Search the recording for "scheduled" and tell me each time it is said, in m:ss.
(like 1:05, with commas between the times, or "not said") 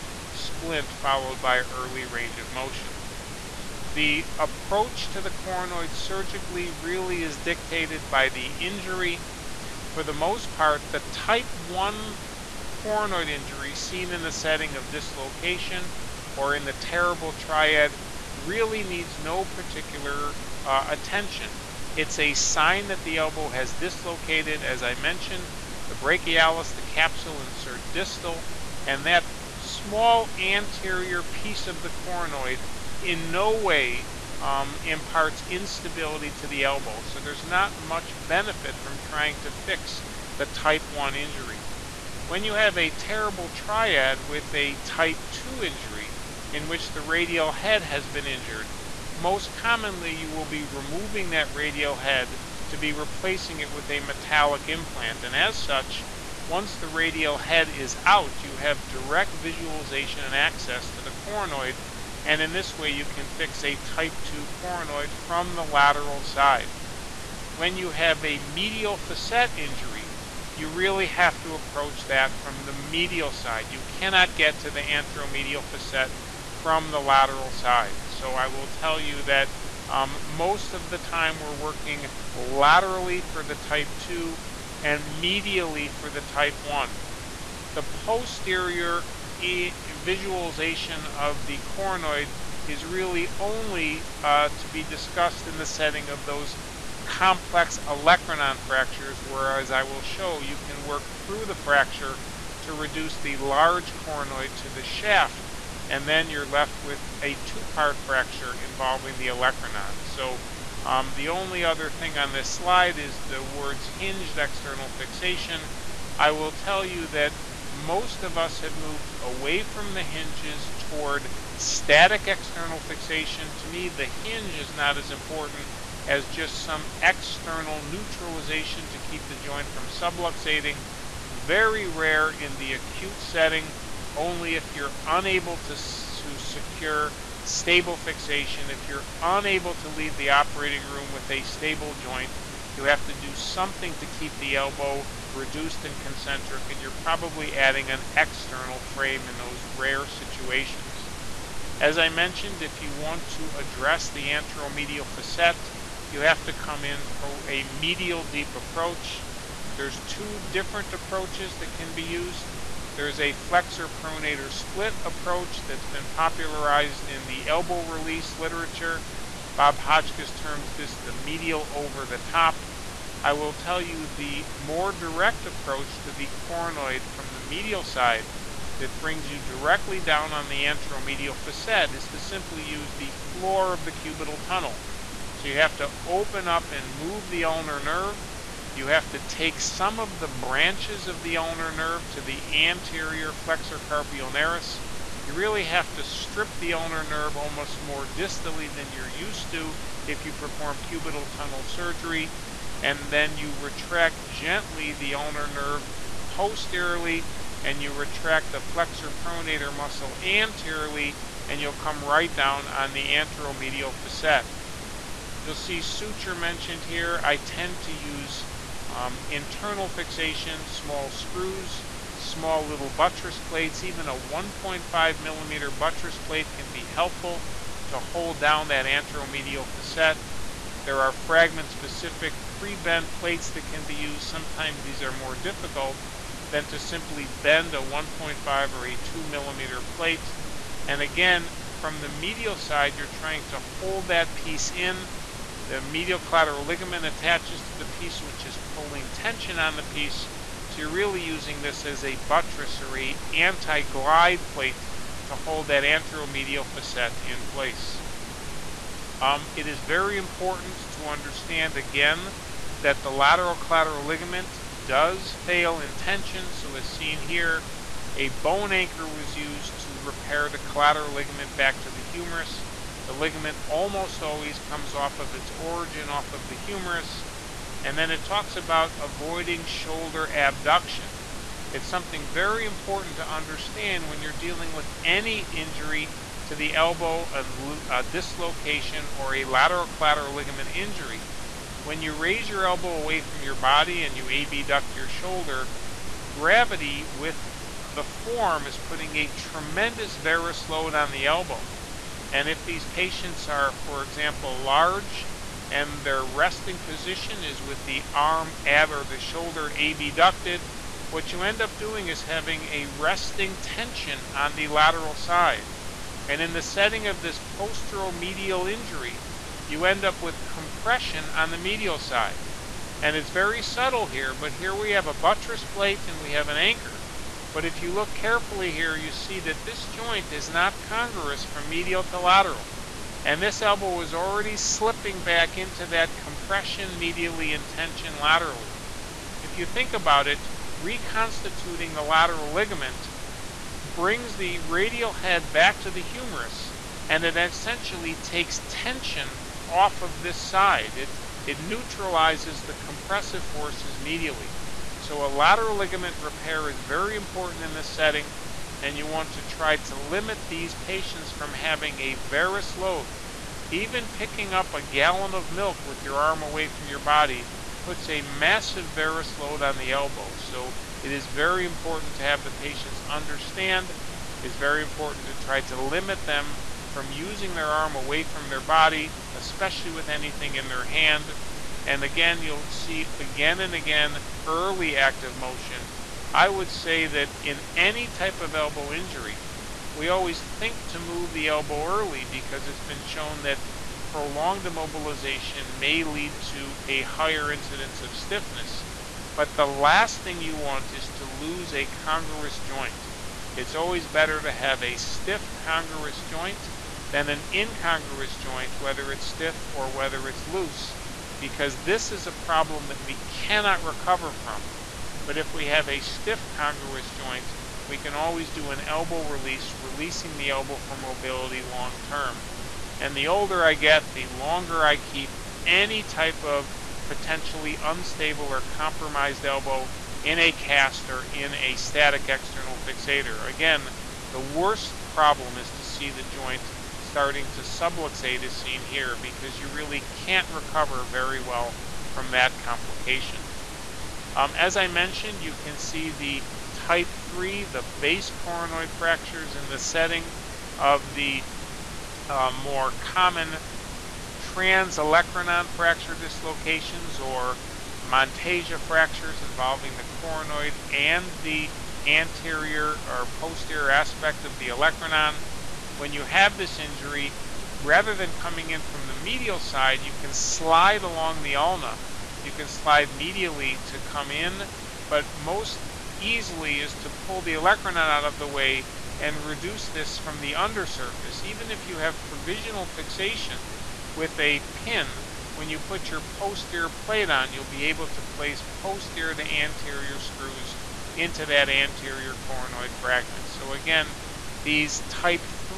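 not said.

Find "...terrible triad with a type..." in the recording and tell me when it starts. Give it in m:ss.
0:42.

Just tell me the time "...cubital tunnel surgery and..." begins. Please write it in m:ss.
3:20.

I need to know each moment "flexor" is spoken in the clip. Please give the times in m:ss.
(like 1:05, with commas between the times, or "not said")
2:43, 3:13, 3:28.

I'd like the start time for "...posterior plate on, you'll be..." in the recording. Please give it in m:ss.
8:06.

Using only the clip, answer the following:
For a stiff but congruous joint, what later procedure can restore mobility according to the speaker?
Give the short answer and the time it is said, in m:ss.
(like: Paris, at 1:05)
an elbow release, at 6:58.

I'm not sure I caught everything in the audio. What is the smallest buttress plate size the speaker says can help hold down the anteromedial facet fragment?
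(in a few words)
1.5 millimeter.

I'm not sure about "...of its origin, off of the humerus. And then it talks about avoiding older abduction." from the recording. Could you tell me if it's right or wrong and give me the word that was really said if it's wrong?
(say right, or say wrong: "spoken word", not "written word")
wrong: "shoulder", not "older".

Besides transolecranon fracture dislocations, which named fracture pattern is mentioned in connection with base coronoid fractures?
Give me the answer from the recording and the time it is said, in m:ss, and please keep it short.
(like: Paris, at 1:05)
Monteggia fractures, at 7:37.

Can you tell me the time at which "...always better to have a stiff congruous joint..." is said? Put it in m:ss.
6:43.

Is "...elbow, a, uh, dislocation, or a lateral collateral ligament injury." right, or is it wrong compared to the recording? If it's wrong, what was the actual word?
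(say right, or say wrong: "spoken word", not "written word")
right.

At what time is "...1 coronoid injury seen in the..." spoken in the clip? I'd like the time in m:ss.
0:11.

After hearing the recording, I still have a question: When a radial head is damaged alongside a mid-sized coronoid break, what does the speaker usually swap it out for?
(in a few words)
a metallic implant.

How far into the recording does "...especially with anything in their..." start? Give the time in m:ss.
6:19.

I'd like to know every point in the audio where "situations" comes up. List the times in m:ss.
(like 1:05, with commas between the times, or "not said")
2:30.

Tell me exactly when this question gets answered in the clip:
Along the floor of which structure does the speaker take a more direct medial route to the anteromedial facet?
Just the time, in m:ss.
3:03.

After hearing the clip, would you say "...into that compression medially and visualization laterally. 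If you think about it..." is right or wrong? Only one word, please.
wrong.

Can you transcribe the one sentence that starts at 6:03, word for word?
Even picking up a gallon of milk with your arm away from your body puts a massive varus load on the elbow.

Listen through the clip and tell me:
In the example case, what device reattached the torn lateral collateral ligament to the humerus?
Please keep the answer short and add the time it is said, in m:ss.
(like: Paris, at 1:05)
a bone anchor, at 4:28.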